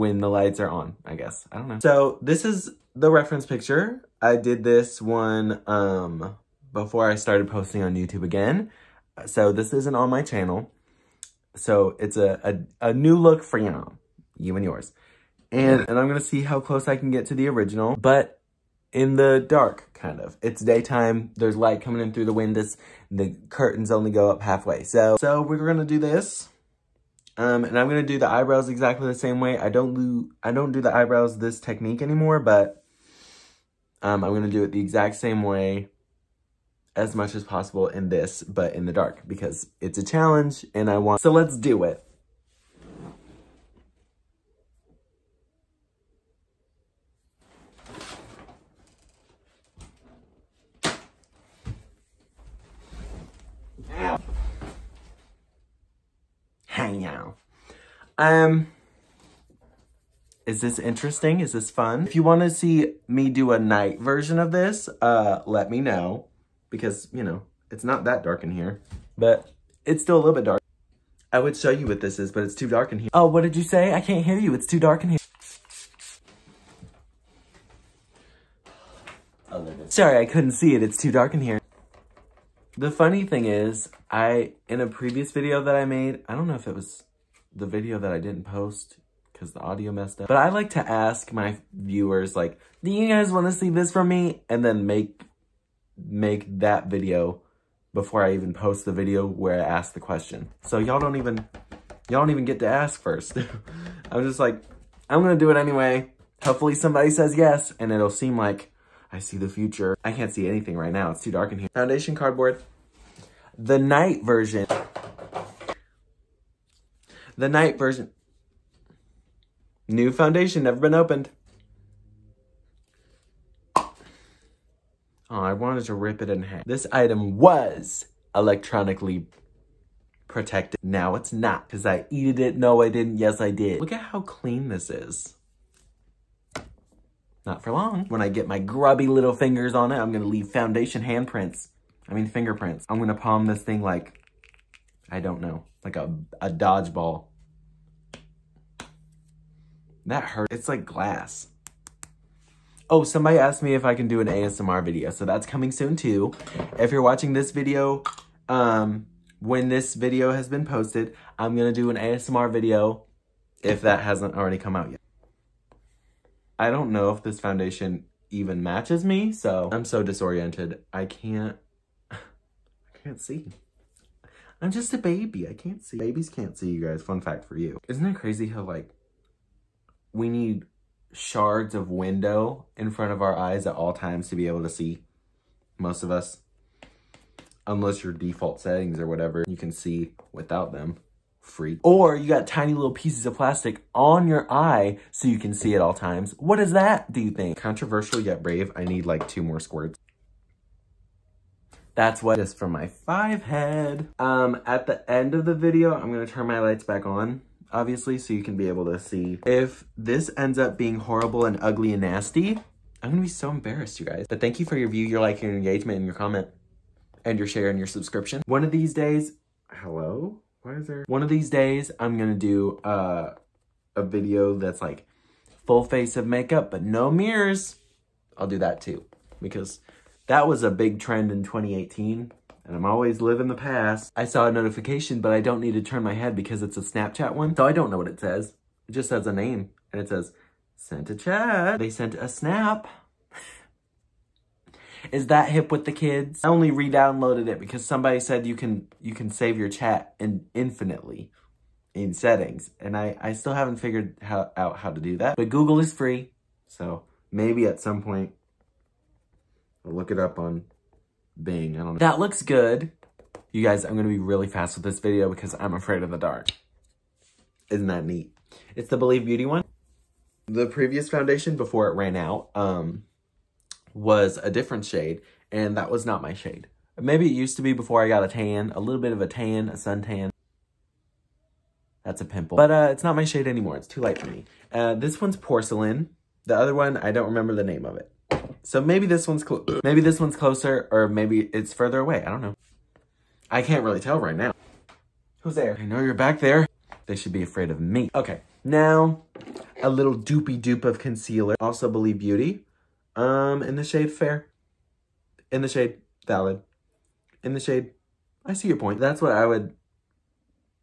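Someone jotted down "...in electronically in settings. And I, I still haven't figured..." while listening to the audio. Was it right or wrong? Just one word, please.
wrong.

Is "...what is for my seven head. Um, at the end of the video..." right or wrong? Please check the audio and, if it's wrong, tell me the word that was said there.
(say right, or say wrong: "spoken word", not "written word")
wrong: "five", not "seven".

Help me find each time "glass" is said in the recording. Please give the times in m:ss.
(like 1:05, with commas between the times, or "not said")
2:30.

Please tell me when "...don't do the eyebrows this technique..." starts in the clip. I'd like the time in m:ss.
0:30.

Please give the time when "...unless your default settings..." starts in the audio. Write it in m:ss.
3:07.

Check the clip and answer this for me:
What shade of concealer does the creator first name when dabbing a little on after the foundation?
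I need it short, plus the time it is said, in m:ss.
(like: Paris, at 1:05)
Fair, at 5:04.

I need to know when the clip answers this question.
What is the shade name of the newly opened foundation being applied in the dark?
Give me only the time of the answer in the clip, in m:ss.
4:45.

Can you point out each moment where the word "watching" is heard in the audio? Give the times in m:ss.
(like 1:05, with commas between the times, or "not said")
2:37.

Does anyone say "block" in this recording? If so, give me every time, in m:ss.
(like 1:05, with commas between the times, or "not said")
not said.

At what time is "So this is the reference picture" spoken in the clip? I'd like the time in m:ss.
0:01.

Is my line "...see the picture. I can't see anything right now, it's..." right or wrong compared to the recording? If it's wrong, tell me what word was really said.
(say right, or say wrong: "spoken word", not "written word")
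wrong: "future", not "picture".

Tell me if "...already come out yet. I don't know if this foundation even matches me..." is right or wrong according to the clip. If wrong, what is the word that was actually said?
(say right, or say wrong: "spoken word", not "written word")
right.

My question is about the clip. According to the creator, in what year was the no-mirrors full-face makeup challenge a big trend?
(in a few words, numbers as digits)
2018.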